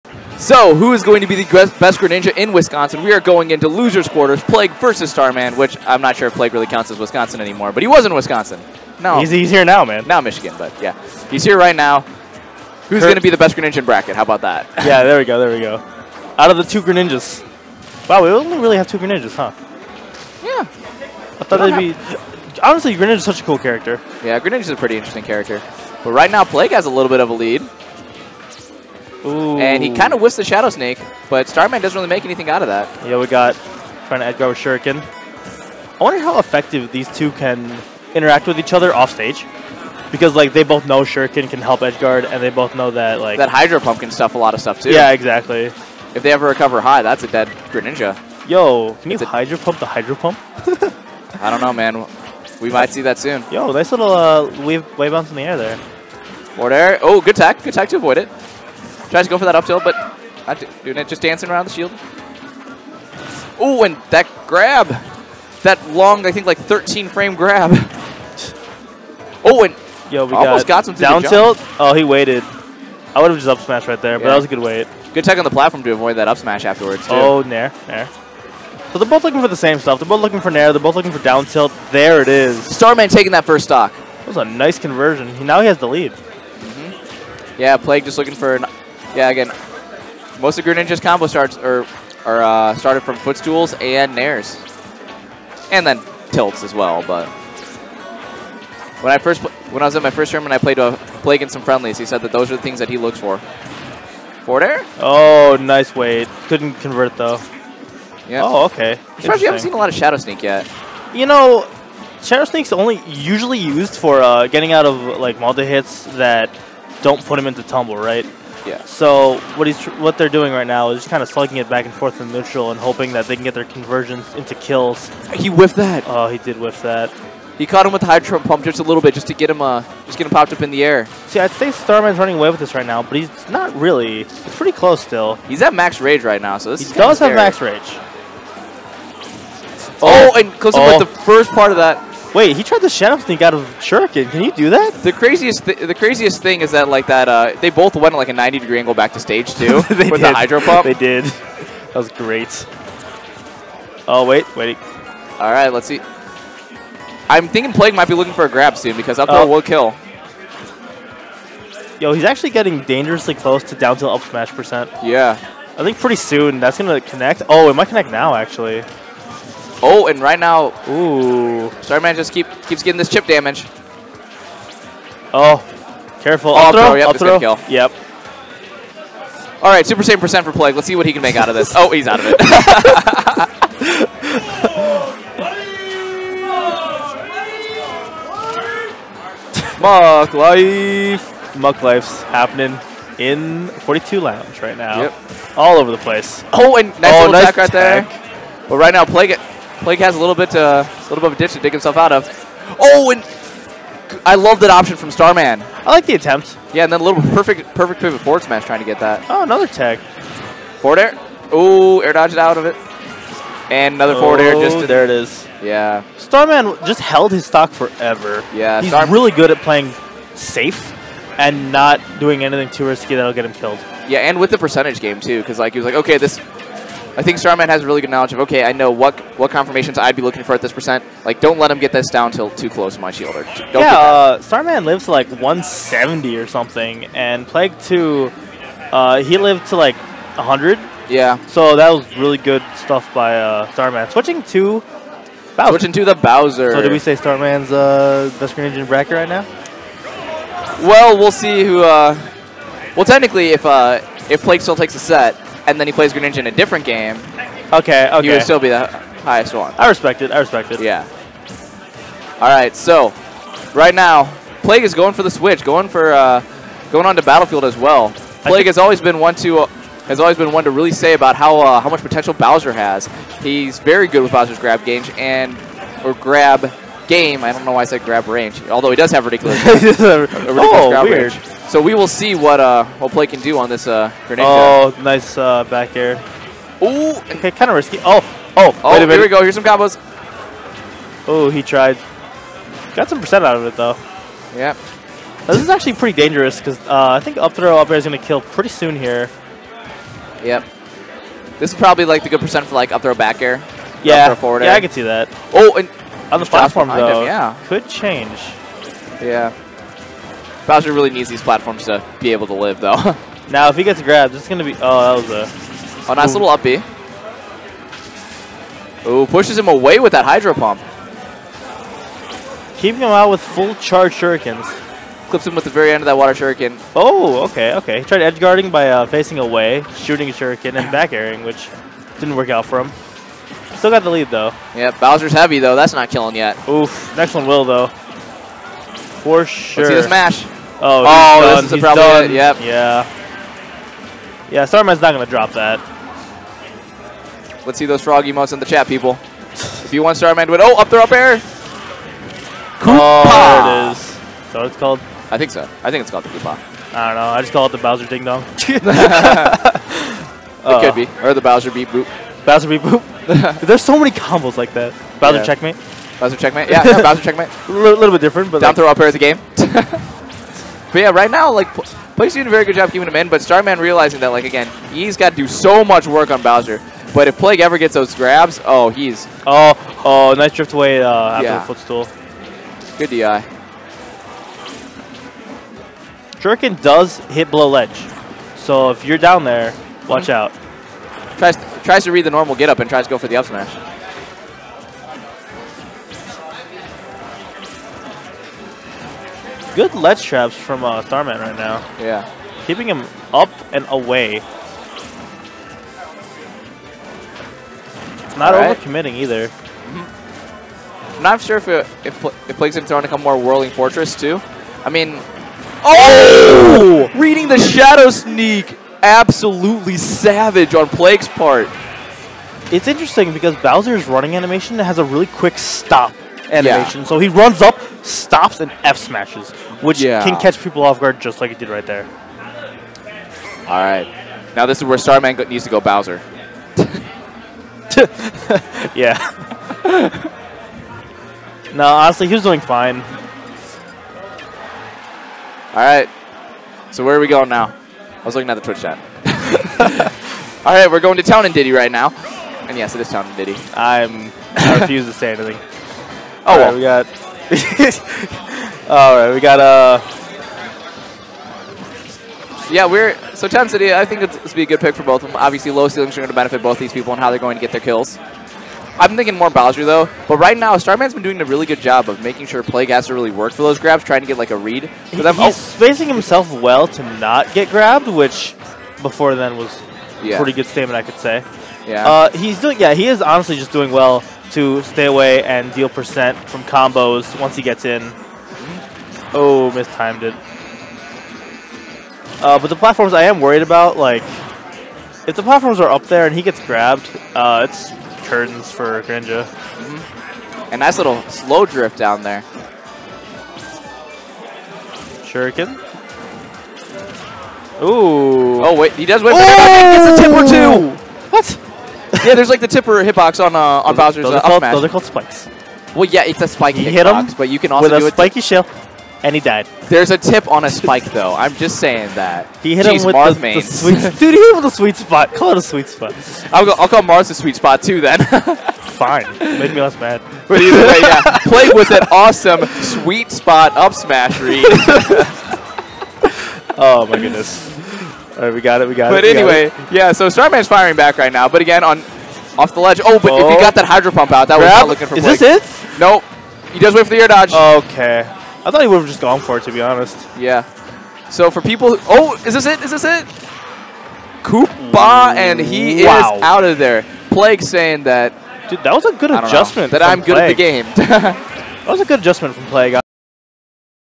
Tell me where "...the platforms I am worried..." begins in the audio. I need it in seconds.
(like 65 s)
492 s.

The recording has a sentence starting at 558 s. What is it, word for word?
Dude, that was a good adjustment.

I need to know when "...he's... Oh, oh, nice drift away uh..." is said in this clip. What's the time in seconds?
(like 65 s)
378 s.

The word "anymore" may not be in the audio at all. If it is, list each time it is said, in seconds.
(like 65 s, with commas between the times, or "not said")
7 s.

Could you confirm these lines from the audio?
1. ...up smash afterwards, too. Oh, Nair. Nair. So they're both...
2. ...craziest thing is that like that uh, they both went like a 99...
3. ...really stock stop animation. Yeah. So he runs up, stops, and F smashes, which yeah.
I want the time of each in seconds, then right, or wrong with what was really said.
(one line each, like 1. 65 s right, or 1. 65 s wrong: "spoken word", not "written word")
1. 76 s right
2. 145 s wrong: "90", not "99"
3. 425 s wrong: "quick", not "stock".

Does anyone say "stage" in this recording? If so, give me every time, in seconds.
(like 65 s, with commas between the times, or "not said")
39 s, 149 s.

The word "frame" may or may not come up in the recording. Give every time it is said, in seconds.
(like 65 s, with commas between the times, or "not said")
66 s.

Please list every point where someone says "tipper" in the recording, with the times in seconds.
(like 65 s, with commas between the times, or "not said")
512 s.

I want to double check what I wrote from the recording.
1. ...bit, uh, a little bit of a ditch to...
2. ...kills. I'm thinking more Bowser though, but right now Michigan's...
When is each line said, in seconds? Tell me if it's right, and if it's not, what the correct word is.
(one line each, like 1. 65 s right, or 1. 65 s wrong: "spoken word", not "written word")
1. 200 s right
2. 467 s wrong: "Starman", not "Michigan".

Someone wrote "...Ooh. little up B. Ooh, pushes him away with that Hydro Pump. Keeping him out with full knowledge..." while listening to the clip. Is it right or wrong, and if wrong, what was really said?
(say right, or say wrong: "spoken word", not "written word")
wrong: "charge", not "knowledge".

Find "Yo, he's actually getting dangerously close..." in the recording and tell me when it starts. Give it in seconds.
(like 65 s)
161 s.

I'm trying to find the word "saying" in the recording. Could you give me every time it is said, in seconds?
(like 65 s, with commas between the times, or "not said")
521 s, 557 s.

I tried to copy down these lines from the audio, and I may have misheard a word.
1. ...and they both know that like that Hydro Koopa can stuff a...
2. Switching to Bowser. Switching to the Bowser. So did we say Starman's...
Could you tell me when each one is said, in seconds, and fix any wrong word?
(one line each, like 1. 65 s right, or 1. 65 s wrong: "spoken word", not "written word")
1. 42 s wrong: "Pump", not "Koopa"
2. 244 s right.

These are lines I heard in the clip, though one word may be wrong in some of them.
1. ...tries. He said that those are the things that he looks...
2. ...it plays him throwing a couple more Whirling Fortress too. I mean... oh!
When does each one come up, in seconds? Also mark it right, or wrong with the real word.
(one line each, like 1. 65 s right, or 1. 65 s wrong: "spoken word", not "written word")
1. 101 s wrong: "friendlies", not "tries"
2. 412 s right.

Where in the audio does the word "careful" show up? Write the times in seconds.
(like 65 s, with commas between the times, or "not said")
176 s.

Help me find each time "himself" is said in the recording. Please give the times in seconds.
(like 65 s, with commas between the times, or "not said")
201 s, 476 s.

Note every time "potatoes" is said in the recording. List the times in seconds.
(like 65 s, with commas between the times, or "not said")
not said.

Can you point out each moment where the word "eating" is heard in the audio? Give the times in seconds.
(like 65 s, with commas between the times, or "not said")
not said.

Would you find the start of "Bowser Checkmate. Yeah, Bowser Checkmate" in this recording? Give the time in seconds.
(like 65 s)
366 s.